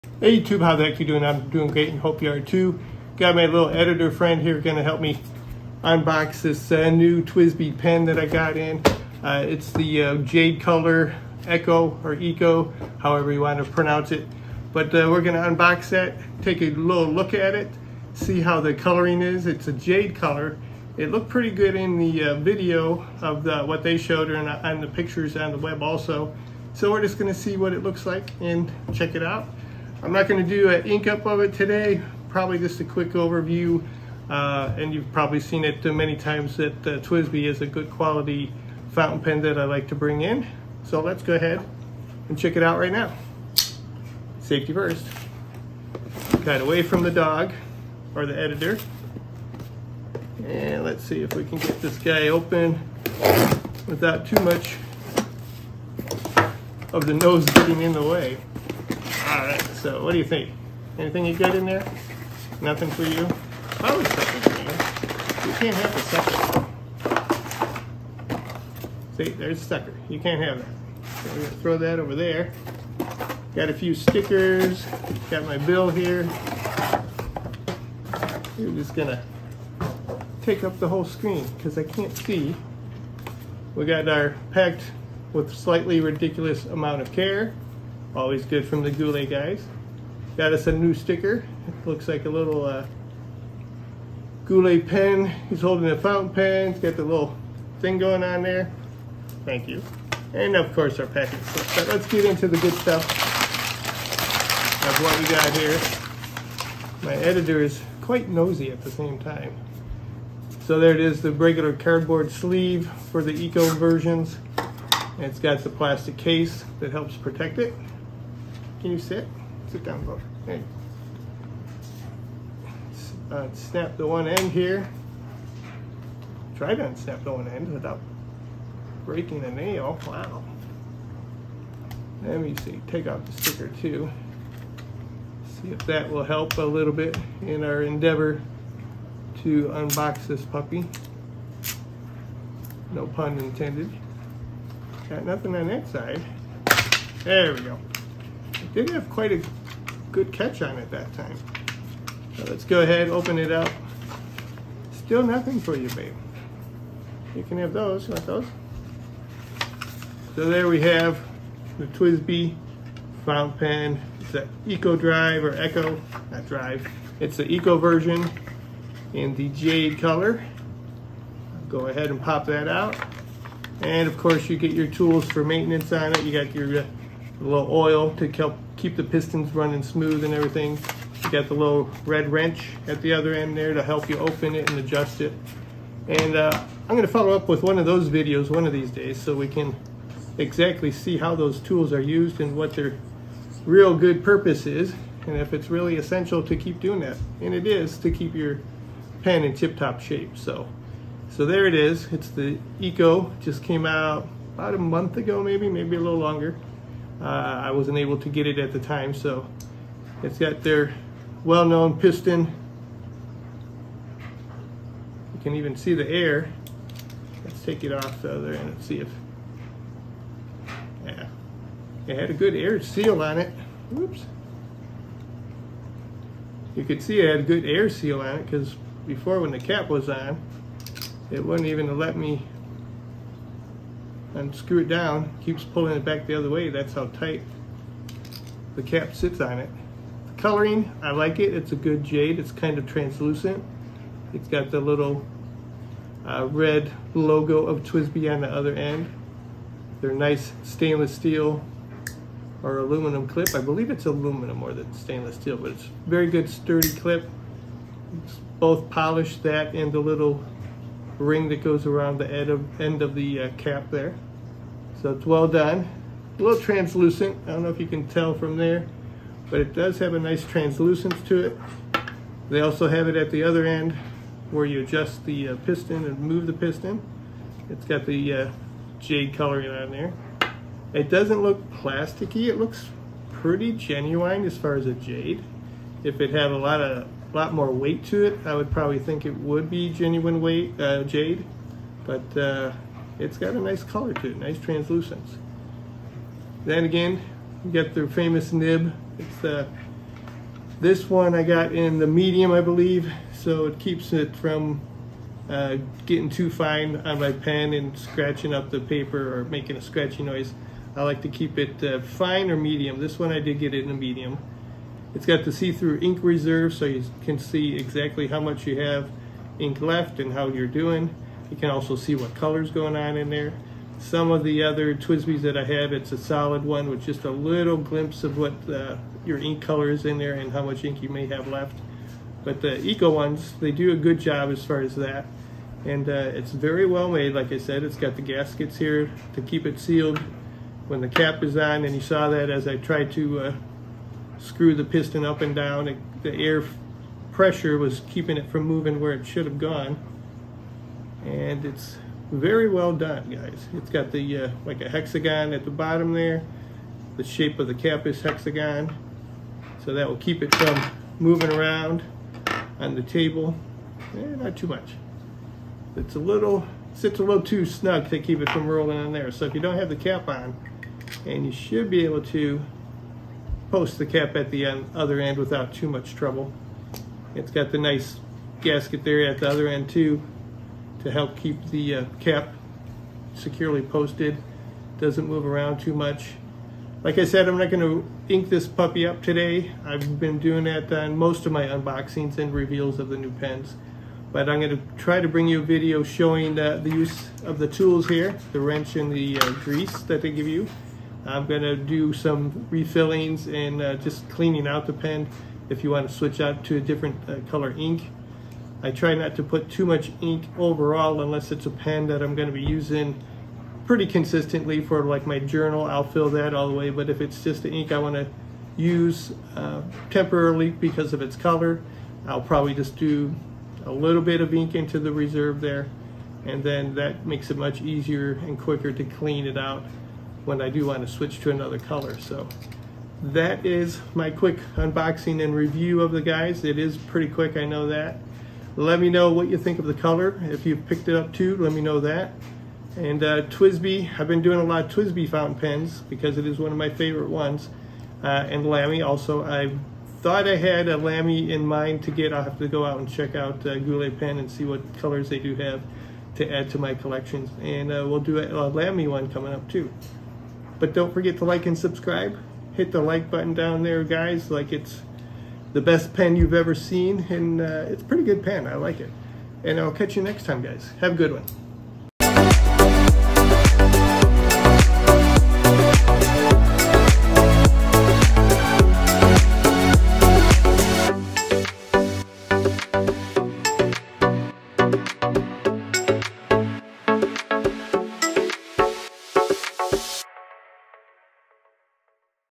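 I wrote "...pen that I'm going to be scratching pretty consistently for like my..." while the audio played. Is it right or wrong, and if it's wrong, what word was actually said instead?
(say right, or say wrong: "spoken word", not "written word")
wrong: "using", not "scratching".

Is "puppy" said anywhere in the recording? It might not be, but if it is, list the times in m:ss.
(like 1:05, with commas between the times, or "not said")
2:20, 6:28.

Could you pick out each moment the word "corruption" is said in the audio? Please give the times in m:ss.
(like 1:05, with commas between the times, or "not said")
not said.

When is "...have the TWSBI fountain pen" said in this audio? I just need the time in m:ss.
2:40.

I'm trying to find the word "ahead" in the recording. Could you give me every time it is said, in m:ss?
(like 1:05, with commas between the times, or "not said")
0:41, 2:32, 2:51.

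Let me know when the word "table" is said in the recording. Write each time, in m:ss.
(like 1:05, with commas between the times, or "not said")
6:03.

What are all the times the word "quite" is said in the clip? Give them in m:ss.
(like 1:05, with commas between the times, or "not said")
1:48, 2:29.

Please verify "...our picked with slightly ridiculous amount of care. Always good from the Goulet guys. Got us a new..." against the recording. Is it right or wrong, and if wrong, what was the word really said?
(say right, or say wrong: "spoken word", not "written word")
wrong: "packed", not "picked".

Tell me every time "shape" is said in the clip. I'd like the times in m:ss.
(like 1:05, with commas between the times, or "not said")
3:19, 5:57.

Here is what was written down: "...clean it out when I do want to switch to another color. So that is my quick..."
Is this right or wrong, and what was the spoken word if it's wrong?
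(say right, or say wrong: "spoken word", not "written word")
right.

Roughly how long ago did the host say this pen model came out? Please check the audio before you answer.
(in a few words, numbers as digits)
About a month ago.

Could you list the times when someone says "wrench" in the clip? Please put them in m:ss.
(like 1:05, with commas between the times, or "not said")
3:02, 6:38.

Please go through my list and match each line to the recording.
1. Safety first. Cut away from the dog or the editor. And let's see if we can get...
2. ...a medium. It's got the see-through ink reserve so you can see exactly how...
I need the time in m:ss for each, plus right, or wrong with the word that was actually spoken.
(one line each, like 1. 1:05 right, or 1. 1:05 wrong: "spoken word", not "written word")
1. 0:44 right
2. 5:13 right.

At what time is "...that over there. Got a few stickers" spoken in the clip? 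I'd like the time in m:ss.
1:11.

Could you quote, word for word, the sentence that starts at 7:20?
If you picked it up too, let me know that.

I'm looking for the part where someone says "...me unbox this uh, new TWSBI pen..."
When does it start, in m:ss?
0:05.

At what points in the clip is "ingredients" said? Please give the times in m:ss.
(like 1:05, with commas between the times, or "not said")
not said.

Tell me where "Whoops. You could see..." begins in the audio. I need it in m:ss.
3:43.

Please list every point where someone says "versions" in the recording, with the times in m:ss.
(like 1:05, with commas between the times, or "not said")
1:53, 2:47.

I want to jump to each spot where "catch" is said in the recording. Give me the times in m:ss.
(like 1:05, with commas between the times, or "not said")
2:30, 7:49.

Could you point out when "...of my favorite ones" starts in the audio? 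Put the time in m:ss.
7:26.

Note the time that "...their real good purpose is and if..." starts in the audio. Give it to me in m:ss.
3:12.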